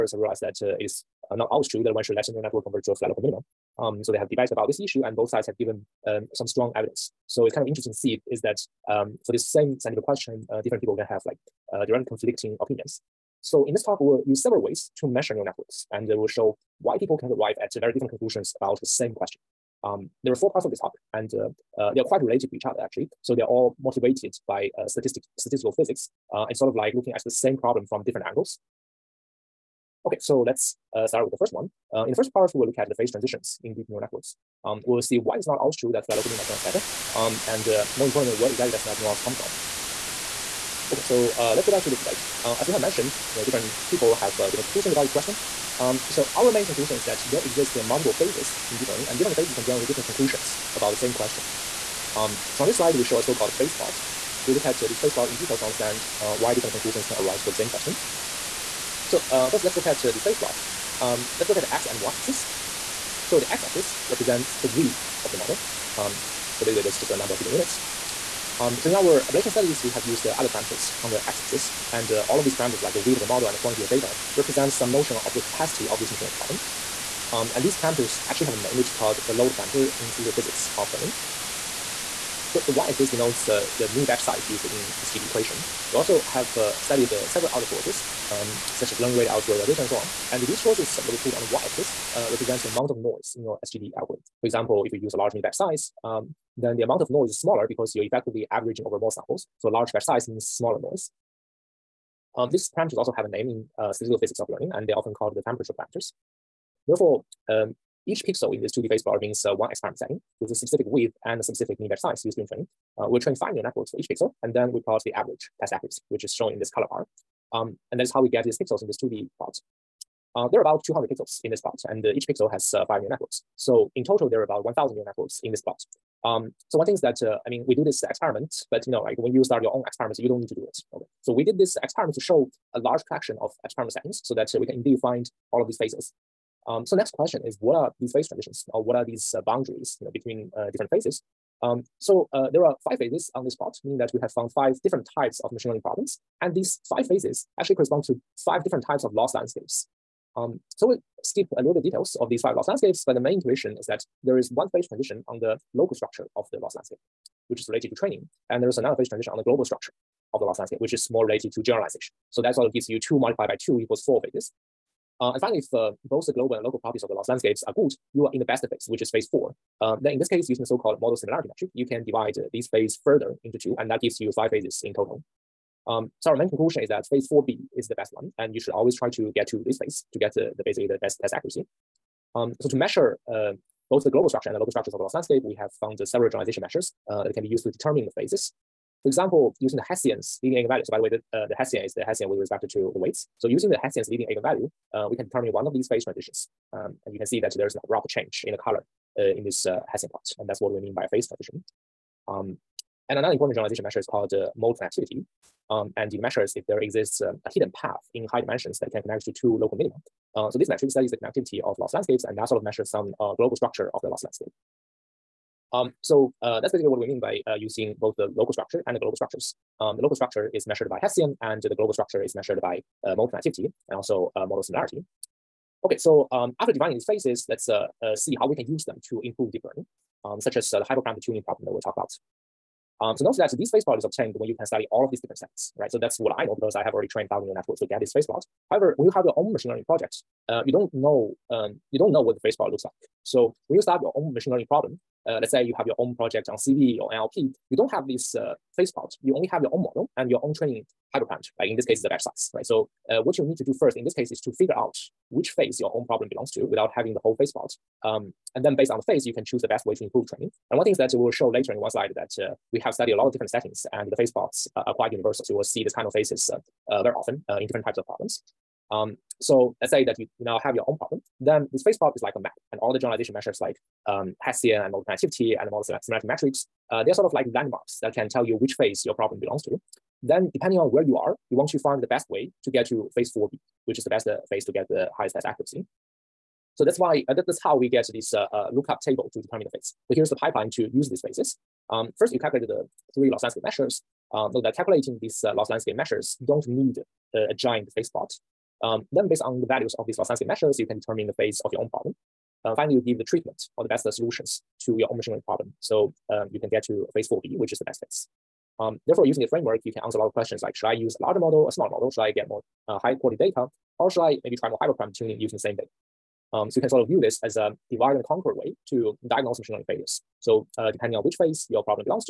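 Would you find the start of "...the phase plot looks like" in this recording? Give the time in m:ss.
4:02.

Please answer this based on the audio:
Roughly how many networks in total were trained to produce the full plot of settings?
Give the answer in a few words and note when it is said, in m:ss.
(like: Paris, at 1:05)
1,000, at 2:04.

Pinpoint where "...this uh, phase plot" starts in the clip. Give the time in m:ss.
4:08.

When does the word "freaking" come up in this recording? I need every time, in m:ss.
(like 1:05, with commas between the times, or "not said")
not said.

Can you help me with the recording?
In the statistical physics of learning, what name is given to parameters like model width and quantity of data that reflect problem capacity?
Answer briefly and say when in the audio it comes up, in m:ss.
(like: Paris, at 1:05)
load parameter, at 1:19.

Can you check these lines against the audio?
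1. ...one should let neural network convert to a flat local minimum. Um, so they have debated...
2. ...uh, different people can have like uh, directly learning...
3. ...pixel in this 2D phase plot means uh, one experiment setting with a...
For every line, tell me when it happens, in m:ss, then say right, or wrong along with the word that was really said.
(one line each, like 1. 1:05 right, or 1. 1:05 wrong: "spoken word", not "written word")
1. 0:01 right
2. 0:10 wrong: "conflicting", not "learning"
3. 1:48 right.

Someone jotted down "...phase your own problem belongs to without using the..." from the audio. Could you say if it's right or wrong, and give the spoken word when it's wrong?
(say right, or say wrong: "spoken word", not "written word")
wrong: "having", not "using".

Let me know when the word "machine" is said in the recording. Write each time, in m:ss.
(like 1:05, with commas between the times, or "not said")
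1:16, 2:25, 3:59, 4:04, 5:05, 5:19.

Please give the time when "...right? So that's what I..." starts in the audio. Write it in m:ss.
3:55.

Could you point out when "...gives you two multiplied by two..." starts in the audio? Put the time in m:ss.
2:42.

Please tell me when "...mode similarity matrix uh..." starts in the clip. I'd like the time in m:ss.
4:35.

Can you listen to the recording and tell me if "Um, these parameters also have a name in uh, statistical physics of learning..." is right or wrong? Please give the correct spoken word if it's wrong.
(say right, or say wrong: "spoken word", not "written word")
right.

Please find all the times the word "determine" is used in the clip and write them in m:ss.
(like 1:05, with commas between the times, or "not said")
3:07, 3:15, 4:49, 5:00.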